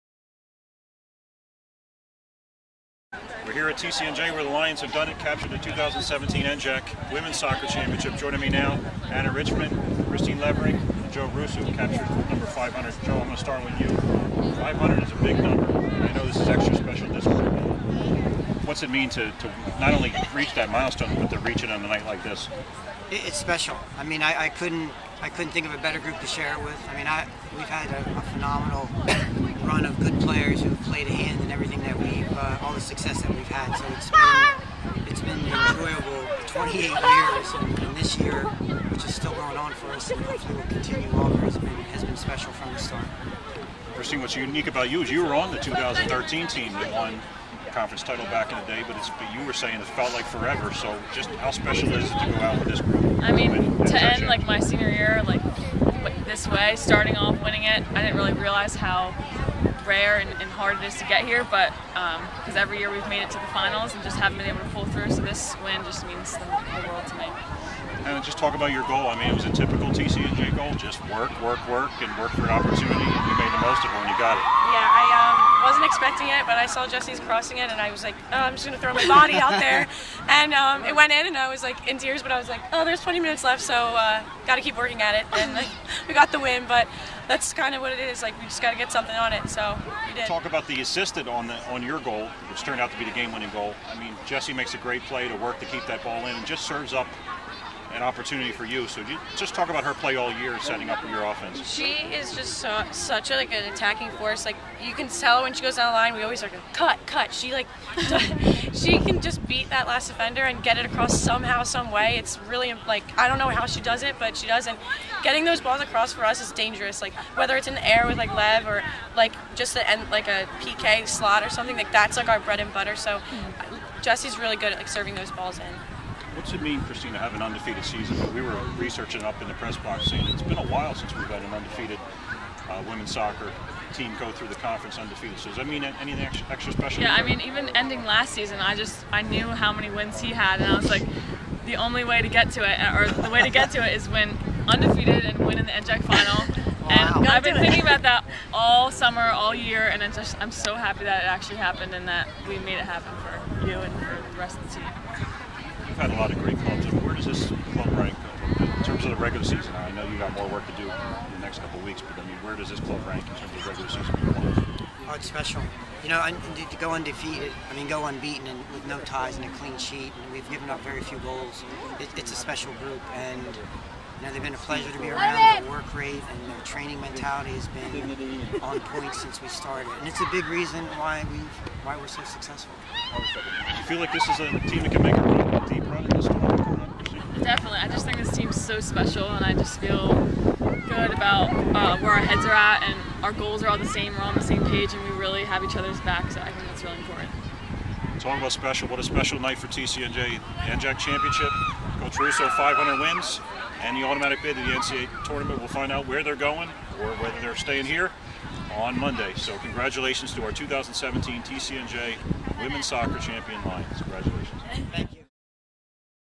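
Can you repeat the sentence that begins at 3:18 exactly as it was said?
Talking about special, what a special night for TCNJ.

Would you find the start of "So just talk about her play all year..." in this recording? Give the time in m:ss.
1:38.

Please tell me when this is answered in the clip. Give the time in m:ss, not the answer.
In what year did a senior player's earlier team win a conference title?
0:45.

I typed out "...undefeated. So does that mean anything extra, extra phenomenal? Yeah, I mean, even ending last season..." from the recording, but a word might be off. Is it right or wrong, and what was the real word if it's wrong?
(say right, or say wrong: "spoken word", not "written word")
wrong: "special", not "phenomenal".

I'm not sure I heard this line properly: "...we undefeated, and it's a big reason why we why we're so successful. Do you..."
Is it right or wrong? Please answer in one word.
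wrong.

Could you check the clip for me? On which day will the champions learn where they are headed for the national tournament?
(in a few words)
Monday.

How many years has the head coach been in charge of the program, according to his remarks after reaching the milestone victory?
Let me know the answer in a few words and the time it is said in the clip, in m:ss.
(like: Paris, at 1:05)
28, at 0:36.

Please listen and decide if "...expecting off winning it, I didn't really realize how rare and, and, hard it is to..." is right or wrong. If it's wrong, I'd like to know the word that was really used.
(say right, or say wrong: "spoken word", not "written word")
wrong: "starting", not "expecting".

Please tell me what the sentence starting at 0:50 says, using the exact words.
So just how special is it to go out with this group?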